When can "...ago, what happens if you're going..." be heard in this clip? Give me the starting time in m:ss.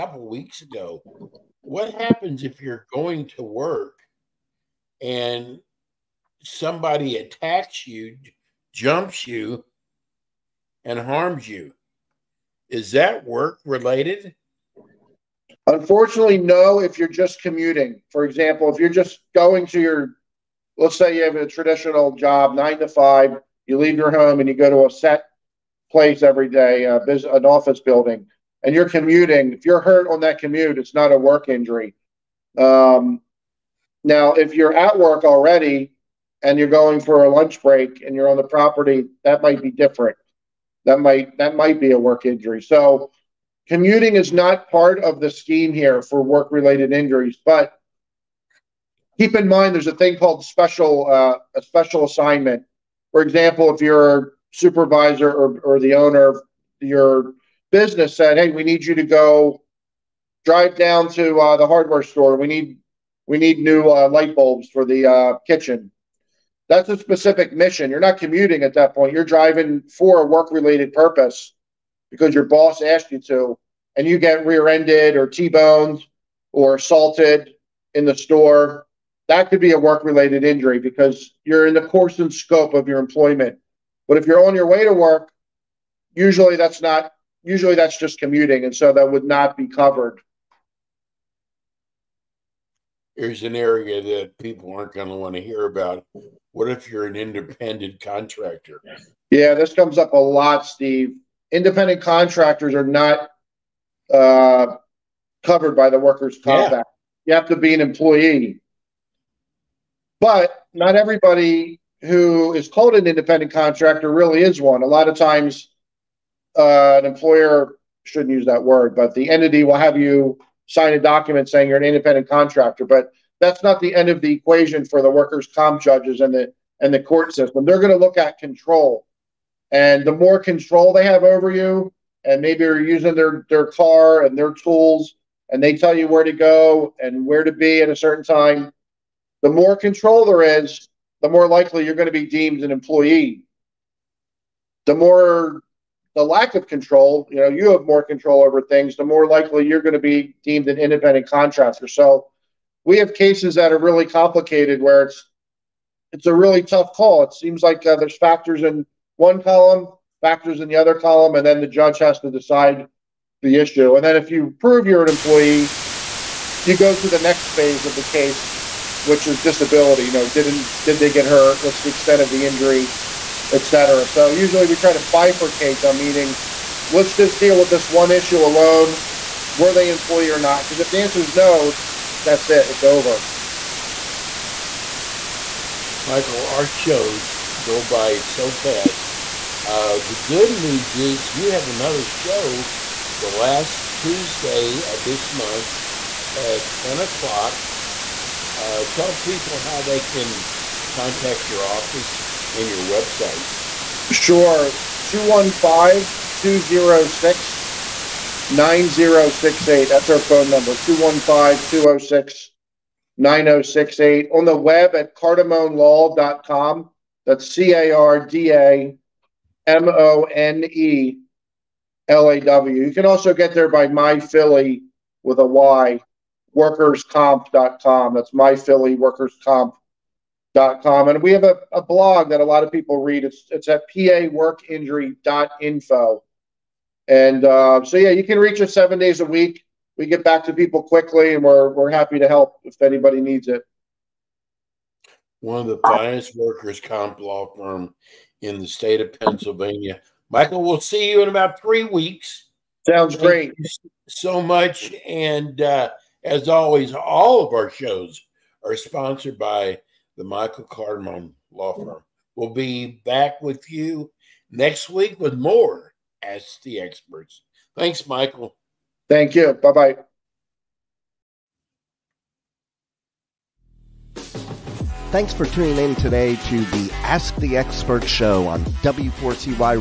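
0:00.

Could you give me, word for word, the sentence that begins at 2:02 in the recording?
But that's not the end of the equation for the workers' comp judges and the and the court system.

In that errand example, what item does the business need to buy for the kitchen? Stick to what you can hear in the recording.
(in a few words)
light bulbs.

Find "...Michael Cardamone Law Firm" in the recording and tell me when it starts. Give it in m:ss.
4:20.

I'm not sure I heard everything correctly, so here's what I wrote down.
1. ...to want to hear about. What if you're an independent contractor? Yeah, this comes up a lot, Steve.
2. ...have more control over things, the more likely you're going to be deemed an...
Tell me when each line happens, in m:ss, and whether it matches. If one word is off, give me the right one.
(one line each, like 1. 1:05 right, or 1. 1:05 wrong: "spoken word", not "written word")
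1. 1:35 right
2. 2:27 right.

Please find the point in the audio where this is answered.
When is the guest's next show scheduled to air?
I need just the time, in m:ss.
3:13.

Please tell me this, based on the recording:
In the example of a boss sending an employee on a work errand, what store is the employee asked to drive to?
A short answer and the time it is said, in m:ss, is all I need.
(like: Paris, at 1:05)
hardware store, at 1:01.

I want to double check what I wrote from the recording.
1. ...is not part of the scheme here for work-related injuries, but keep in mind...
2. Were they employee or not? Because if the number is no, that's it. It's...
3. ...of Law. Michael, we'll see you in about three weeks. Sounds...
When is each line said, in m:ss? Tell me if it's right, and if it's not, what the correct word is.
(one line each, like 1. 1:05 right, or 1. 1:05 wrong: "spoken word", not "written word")
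1. 0:44 right
2. 2:59 wrong: "answer", not "number"
3. 4:09 wrong: "Pennsylvania", not "Law".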